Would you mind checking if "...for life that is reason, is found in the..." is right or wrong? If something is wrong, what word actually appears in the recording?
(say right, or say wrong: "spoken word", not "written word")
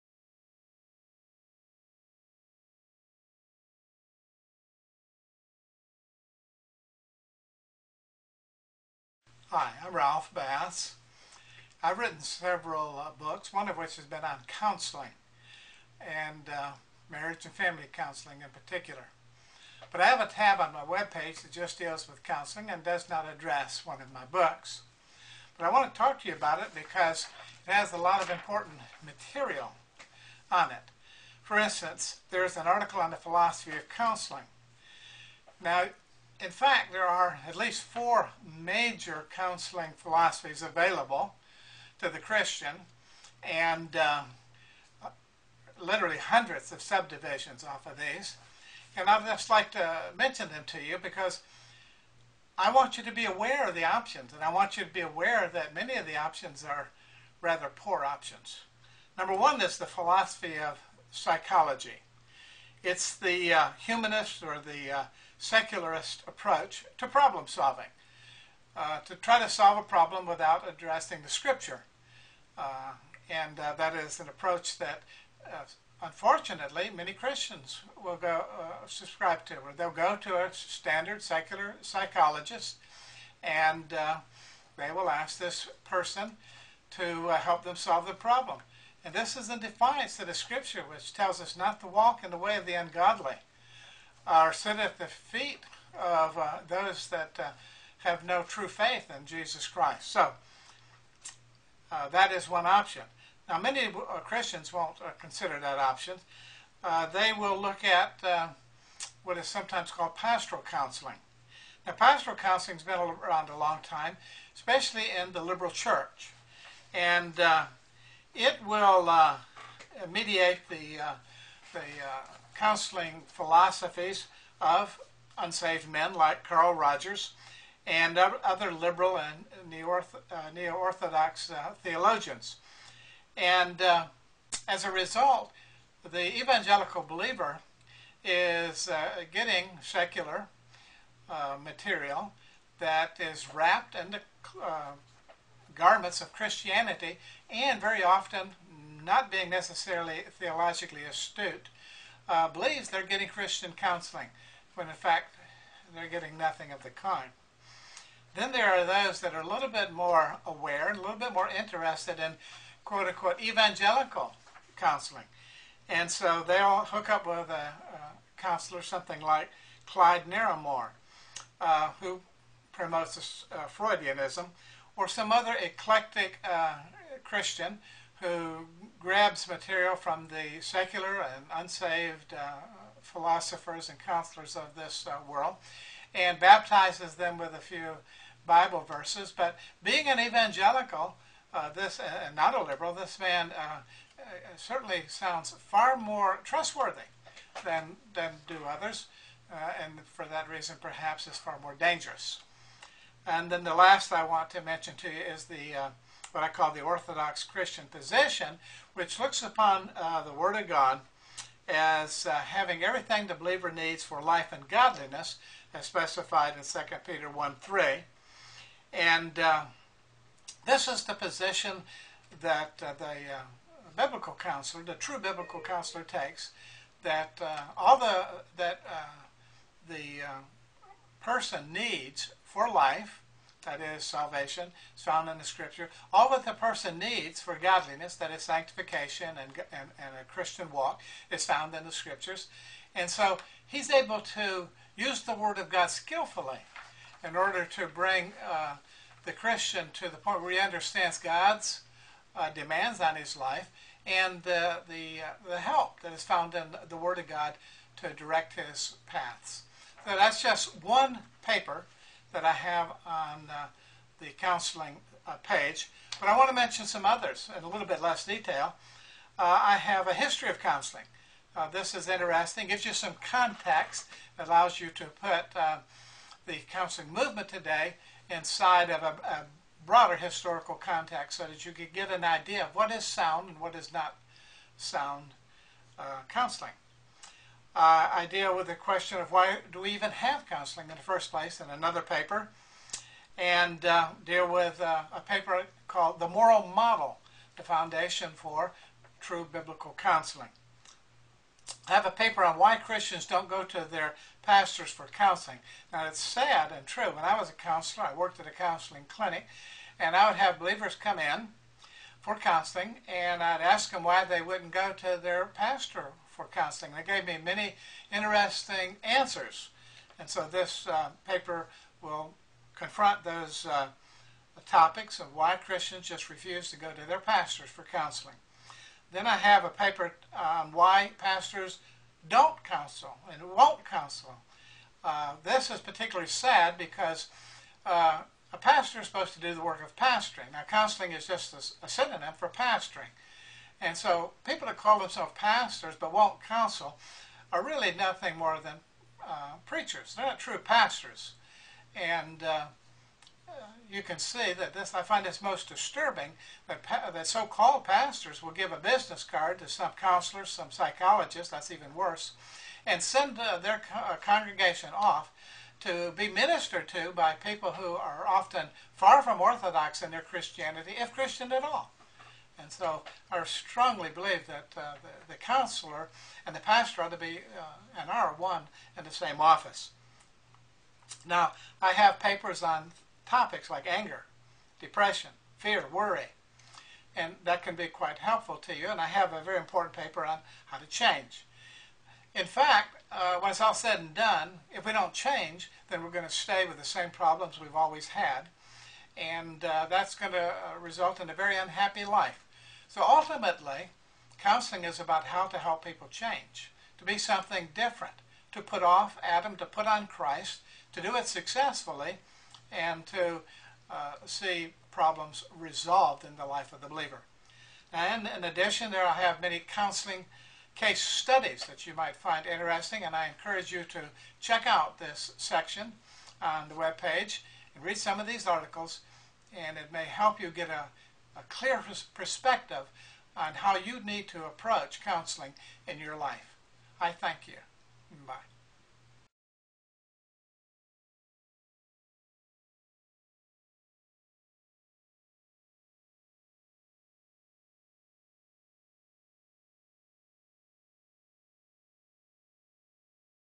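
wrong: "salvation", not "reason".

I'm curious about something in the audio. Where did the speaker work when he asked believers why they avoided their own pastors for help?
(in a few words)
a counseling clinic.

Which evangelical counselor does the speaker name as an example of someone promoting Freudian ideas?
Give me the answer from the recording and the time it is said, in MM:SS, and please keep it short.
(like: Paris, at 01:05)
Clyde Narramore, at 02:49.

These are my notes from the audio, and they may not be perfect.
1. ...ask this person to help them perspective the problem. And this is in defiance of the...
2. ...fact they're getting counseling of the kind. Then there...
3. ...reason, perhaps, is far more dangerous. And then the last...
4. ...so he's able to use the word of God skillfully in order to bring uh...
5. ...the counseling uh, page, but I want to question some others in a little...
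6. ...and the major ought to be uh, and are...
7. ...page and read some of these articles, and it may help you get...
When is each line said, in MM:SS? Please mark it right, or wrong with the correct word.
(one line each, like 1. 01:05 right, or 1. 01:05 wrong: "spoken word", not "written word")
1. 01:25 wrong: "solve", not "perspective"
2. 02:34 wrong: "nothing", not "counseling"
3. 03:20 right
4. 04:03 right
5. 04:24 wrong: "mention", not "question"
6. 06:16 wrong: "pastor", not "major"
7. 07:06 right.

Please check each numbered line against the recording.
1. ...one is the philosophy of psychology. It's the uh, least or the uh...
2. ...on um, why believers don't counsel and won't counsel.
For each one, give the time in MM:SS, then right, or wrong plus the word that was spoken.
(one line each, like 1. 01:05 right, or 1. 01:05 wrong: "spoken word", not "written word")
1. 00:59 wrong: "humanist", not "least"
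2. 05:30 wrong: "pastors", not "believers".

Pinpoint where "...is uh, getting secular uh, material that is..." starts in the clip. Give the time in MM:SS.
02:18.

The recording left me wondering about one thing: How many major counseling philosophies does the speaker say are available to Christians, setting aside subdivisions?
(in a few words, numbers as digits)
4.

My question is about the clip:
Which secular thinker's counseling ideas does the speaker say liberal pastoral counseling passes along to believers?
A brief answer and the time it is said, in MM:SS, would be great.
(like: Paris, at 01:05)
Carl Rogers, at 02:06.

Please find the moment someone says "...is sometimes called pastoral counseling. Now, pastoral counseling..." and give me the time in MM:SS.
01:49.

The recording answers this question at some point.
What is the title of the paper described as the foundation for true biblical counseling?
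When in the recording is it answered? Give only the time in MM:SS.
04:56.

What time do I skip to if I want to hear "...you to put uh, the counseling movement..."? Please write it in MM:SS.
04:34.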